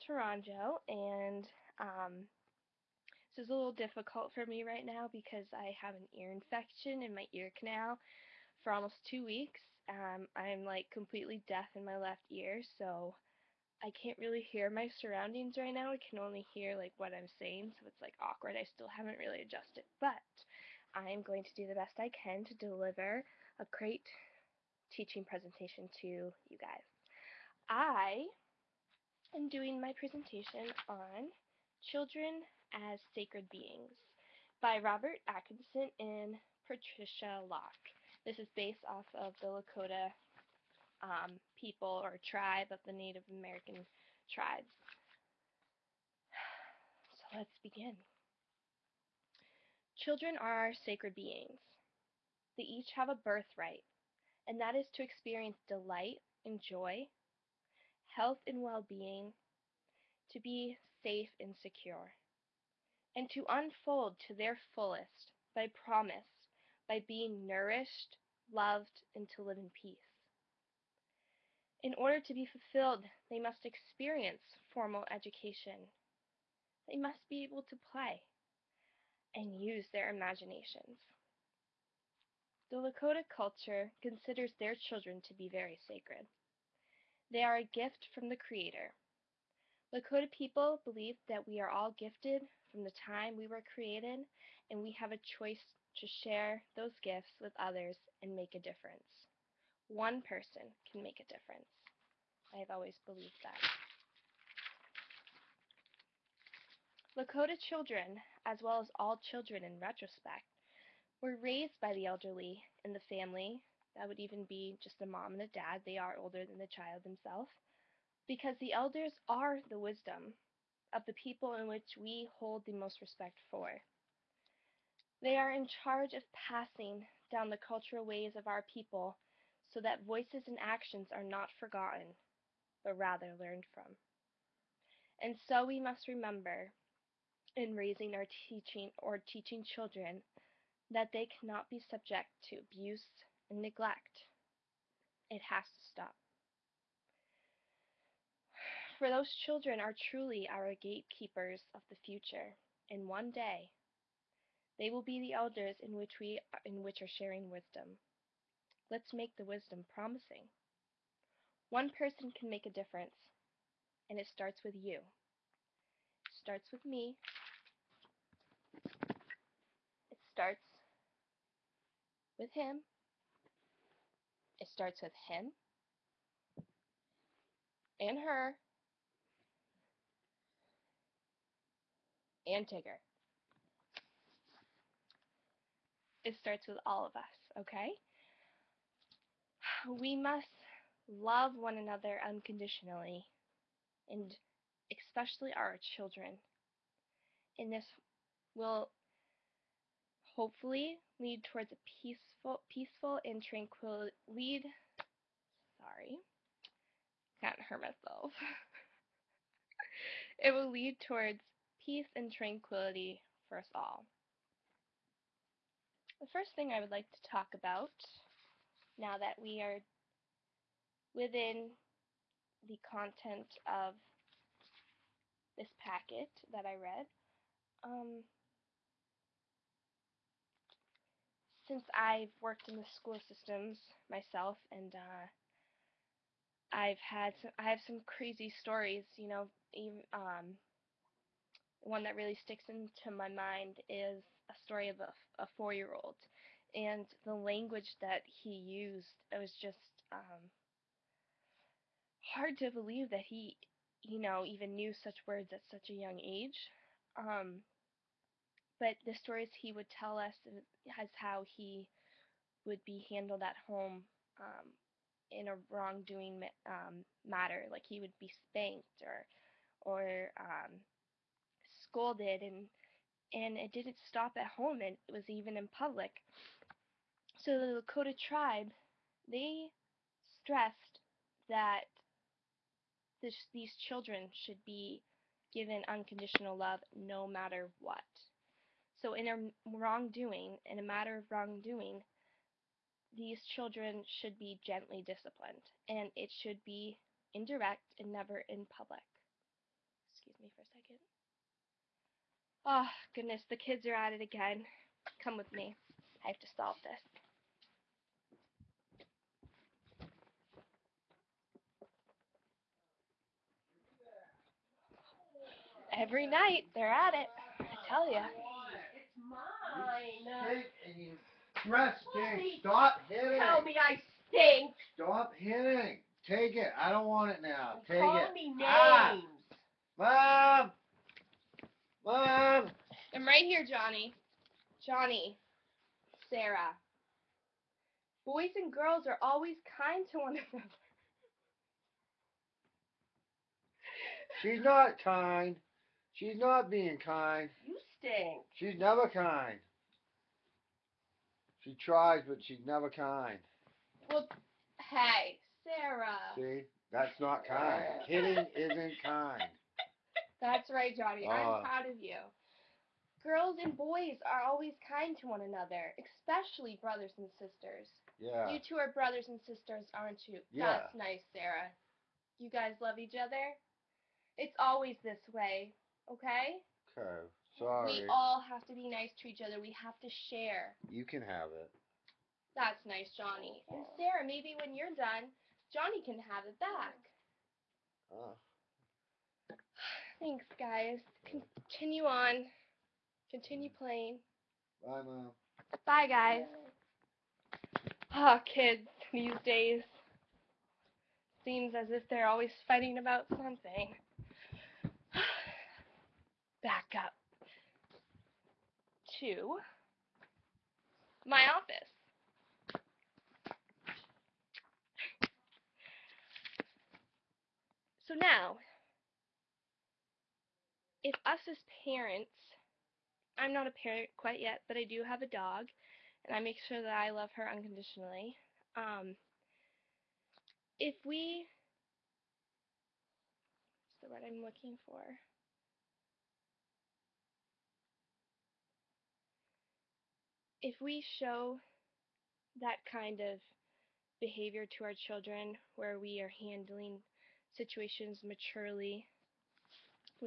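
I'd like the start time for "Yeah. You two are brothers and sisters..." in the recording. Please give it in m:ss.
6:08.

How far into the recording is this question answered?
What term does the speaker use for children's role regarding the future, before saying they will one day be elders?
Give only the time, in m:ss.
2:30.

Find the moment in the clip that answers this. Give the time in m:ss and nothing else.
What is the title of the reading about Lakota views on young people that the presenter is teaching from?
0:31.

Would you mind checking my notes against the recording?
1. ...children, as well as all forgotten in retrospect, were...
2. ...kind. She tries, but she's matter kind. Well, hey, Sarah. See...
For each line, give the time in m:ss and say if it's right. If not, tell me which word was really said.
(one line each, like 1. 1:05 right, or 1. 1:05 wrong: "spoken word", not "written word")
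1. 1:47 wrong: "children", not "forgotten"
2. 5:49 wrong: "never", not "matter".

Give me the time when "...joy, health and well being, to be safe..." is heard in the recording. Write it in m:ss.
0:56.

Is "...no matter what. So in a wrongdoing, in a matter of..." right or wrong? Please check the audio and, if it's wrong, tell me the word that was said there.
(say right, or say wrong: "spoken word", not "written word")
right.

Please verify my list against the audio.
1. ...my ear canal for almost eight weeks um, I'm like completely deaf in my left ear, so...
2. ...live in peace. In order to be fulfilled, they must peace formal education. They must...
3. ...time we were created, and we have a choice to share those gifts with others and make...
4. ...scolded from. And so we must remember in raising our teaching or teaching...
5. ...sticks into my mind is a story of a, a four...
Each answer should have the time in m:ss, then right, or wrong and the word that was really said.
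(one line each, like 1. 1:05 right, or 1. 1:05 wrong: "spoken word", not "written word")
1. 0:07 wrong: "two", not "eight"
2. 1:09 wrong: "experience", not "peace"
3. 1:33 right
4. 2:13 wrong: "learned", not "scolded"
5. 4:02 right.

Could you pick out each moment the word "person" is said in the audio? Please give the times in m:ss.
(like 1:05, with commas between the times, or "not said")
1:40, 2:41.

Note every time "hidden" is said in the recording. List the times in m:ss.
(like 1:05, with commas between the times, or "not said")
not said.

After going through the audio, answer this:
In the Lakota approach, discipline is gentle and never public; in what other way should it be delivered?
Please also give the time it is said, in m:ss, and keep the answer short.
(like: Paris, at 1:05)
indirect, at 4:57.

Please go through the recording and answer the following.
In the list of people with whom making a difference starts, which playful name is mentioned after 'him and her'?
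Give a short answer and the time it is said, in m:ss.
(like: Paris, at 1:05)
Tigger, at 3:02.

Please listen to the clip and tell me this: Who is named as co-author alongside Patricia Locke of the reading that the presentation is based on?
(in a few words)
Robert Atkinson.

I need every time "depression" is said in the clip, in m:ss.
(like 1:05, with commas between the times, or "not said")
not said.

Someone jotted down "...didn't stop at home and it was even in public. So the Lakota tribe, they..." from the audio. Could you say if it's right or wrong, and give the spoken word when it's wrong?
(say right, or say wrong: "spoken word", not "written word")
right.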